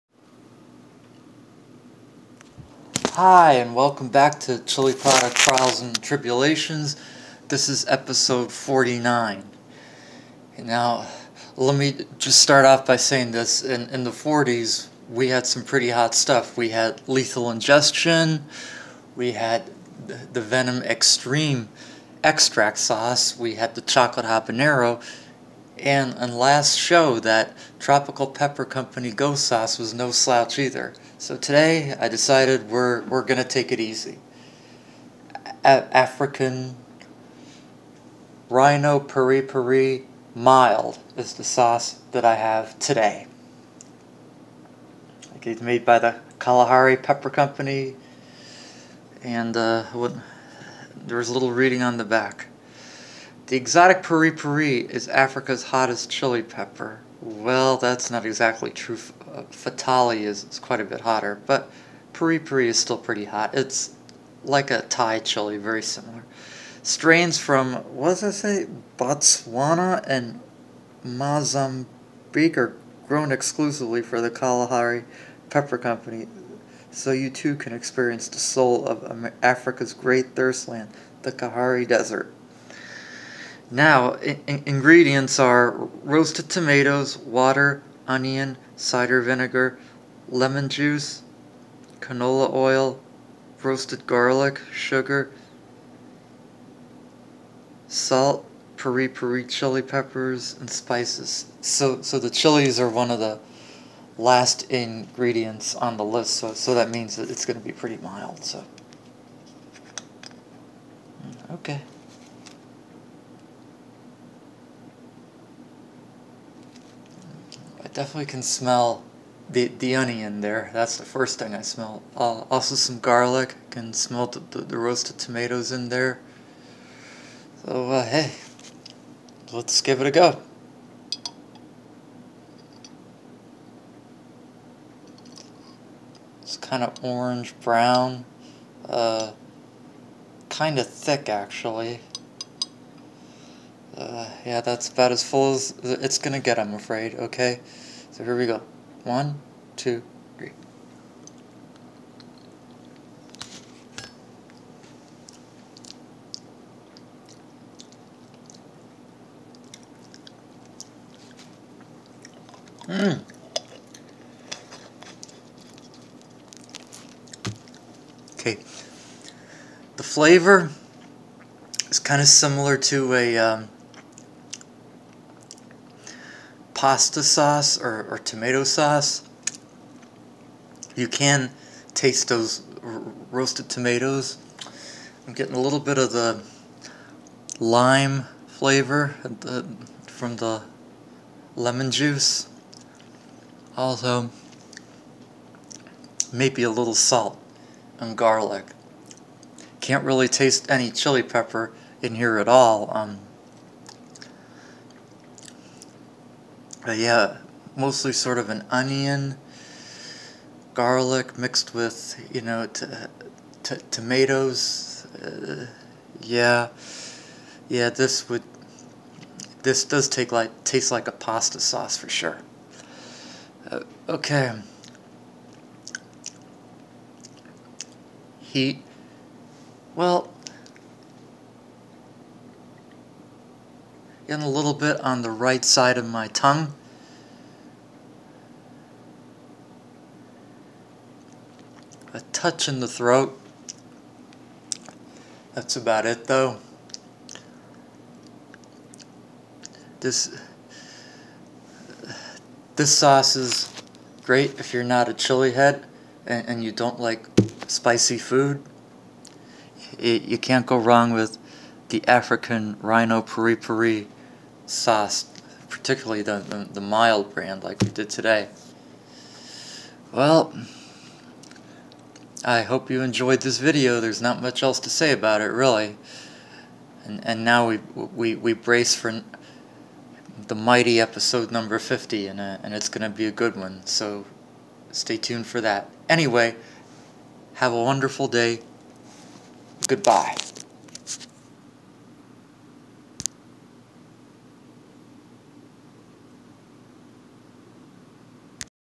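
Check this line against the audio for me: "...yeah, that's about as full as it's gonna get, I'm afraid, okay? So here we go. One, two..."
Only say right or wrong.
right.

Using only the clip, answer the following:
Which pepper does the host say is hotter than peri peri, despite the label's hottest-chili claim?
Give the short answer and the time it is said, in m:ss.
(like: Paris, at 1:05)
Fatali, at 0:59.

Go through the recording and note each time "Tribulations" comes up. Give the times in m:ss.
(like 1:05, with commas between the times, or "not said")
0:06.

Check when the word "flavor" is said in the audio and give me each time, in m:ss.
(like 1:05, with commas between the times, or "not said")
2:50, 3:08.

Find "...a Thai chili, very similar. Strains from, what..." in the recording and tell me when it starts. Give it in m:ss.
1:04.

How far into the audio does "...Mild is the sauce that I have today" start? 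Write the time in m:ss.
0:40.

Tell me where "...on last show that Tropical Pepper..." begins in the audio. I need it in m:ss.
0:26.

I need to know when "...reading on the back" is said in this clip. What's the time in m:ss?
0:51.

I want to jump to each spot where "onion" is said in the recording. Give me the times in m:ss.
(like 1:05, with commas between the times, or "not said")
1:28, 1:59, 3:28.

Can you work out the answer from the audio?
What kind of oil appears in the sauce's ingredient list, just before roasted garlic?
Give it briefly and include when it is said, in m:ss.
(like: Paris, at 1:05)
canola oil, at 1:32.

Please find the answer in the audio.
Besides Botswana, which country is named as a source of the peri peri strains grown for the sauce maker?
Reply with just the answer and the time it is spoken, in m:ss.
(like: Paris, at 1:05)
Mozambique, at 1:11.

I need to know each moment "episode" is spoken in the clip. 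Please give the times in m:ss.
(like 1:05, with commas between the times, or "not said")
0:07, 4:41.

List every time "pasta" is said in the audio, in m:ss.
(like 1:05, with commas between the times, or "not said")
2:56, 3:41.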